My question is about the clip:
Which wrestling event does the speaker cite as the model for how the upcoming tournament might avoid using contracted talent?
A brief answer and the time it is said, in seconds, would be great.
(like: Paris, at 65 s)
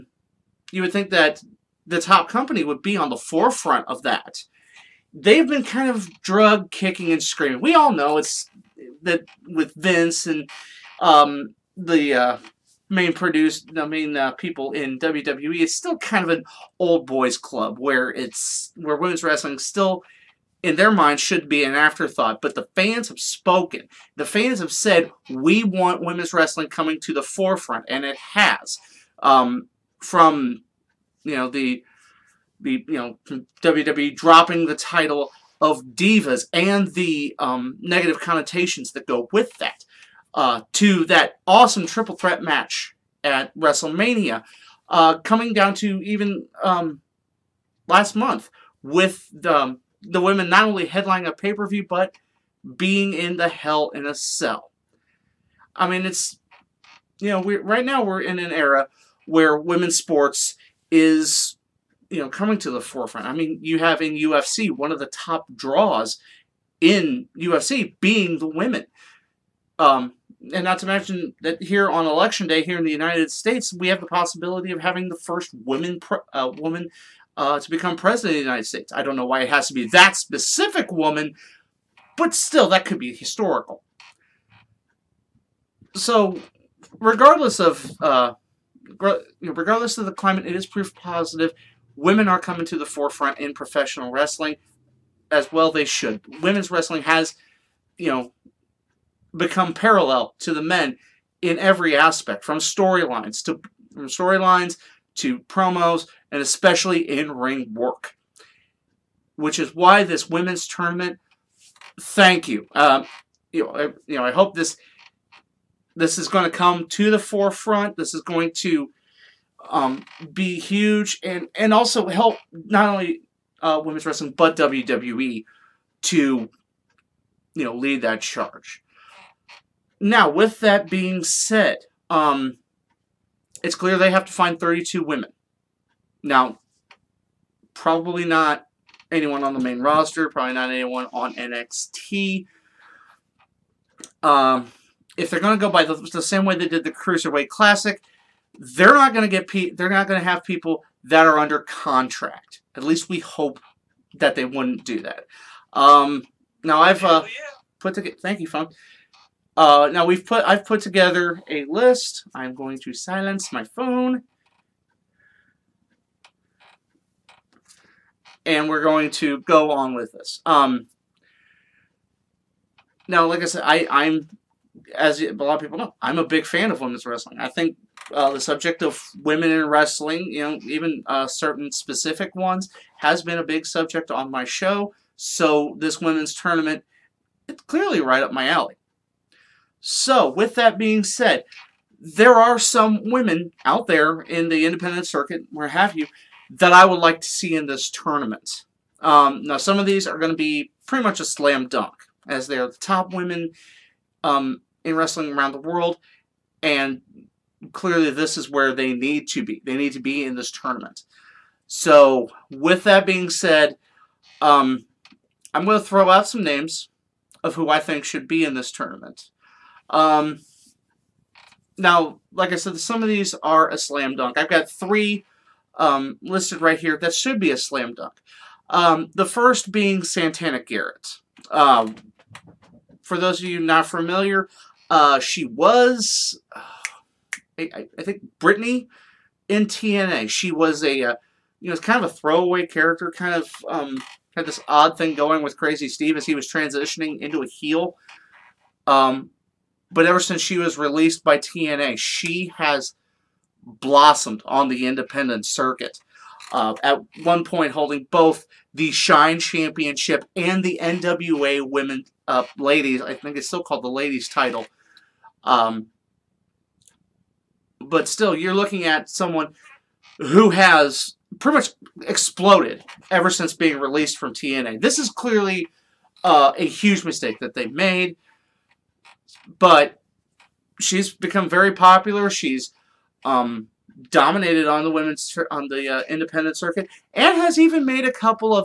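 Cruiserweight Classic, at 146 s.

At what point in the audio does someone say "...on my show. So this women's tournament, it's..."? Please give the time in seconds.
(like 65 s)
184 s.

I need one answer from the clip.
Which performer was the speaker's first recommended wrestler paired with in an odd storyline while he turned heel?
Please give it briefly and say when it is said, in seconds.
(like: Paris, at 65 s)
Crazy Steve, at 245 s.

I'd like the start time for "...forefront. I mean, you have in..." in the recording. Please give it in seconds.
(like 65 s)
62 s.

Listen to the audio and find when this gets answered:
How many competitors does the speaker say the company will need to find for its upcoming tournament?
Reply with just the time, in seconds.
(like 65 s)
134 s.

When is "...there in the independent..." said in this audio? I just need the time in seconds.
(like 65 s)
193 s.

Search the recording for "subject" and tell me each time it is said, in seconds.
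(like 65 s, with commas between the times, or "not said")
178 s, 183 s.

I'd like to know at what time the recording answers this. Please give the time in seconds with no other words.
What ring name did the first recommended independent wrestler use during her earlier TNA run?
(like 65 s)
238 s.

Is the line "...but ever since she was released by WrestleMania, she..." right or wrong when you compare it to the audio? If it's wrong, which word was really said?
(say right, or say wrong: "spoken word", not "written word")
wrong: "TNA", not "WrestleMania".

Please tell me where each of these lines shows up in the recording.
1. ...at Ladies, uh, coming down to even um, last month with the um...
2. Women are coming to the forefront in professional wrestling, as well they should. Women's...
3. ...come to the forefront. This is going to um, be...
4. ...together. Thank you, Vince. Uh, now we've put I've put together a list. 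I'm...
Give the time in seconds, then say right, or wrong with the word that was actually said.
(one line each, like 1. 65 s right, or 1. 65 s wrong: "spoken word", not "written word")
1. 43 s wrong: "WrestleMania", not "Ladies"
2. 91 s right
3. 116 s right
4. 157 s wrong: "Funk", not "Vince".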